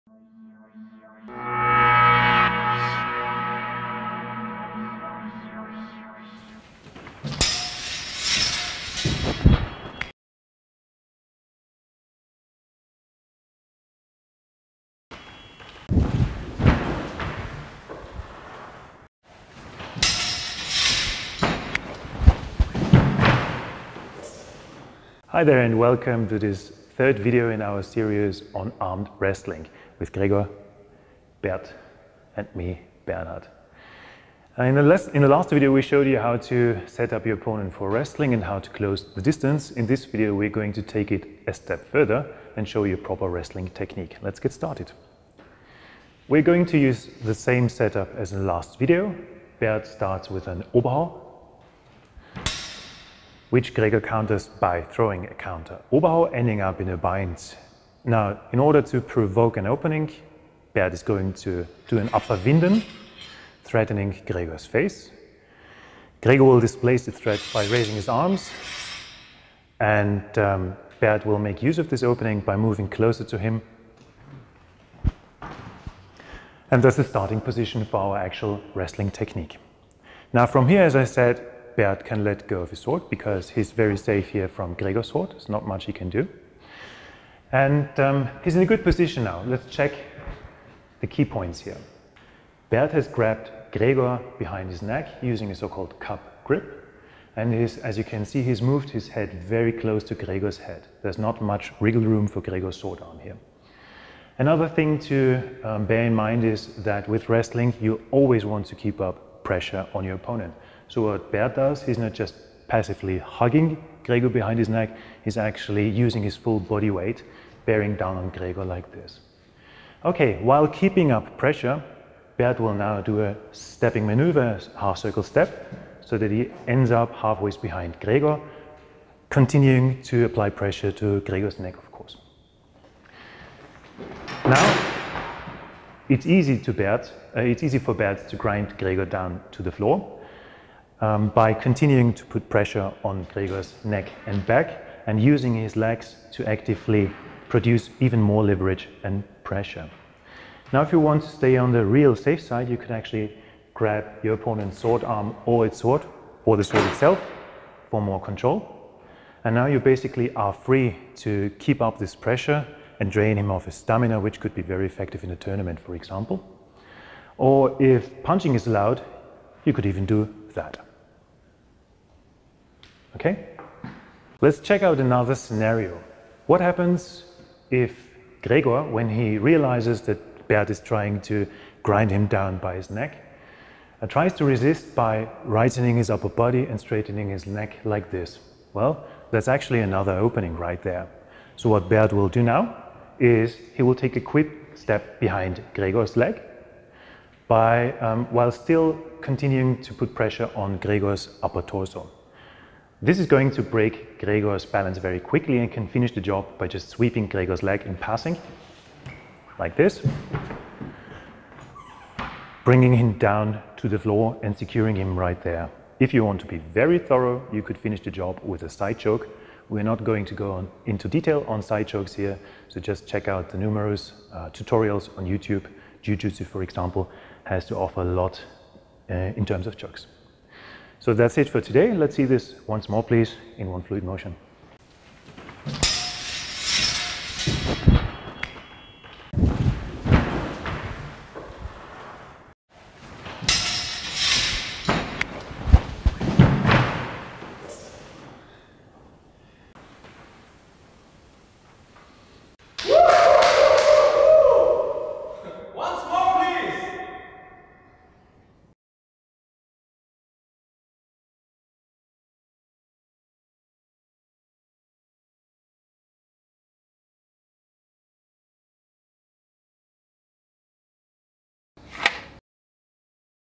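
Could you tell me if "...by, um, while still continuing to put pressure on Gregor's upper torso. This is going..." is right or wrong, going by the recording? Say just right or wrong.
right.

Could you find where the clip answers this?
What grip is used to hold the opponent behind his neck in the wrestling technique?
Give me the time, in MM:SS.
01:35.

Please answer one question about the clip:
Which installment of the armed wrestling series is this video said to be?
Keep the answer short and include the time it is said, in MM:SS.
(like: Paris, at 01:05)
third, at 00:26.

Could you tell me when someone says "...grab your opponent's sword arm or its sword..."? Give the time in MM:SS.
02:33.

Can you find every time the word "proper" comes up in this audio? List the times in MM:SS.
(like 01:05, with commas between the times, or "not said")
00:42.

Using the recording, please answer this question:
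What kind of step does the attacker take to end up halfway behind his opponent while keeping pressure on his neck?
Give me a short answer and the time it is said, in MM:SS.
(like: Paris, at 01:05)
half circle step, at 02:04.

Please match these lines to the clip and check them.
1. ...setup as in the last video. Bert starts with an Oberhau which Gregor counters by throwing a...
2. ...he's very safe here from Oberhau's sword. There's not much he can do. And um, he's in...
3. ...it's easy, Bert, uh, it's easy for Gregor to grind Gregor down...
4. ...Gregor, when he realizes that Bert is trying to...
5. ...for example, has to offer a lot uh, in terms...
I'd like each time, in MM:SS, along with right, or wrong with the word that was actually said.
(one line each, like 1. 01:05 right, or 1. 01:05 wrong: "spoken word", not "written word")
1. 00:47 right
2. 01:23 wrong: "Gregor", not "Oberhau"
3. 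02:16 wrong: "Bert", not "Gregor"
4. 02:58 right
5. 03:46 right.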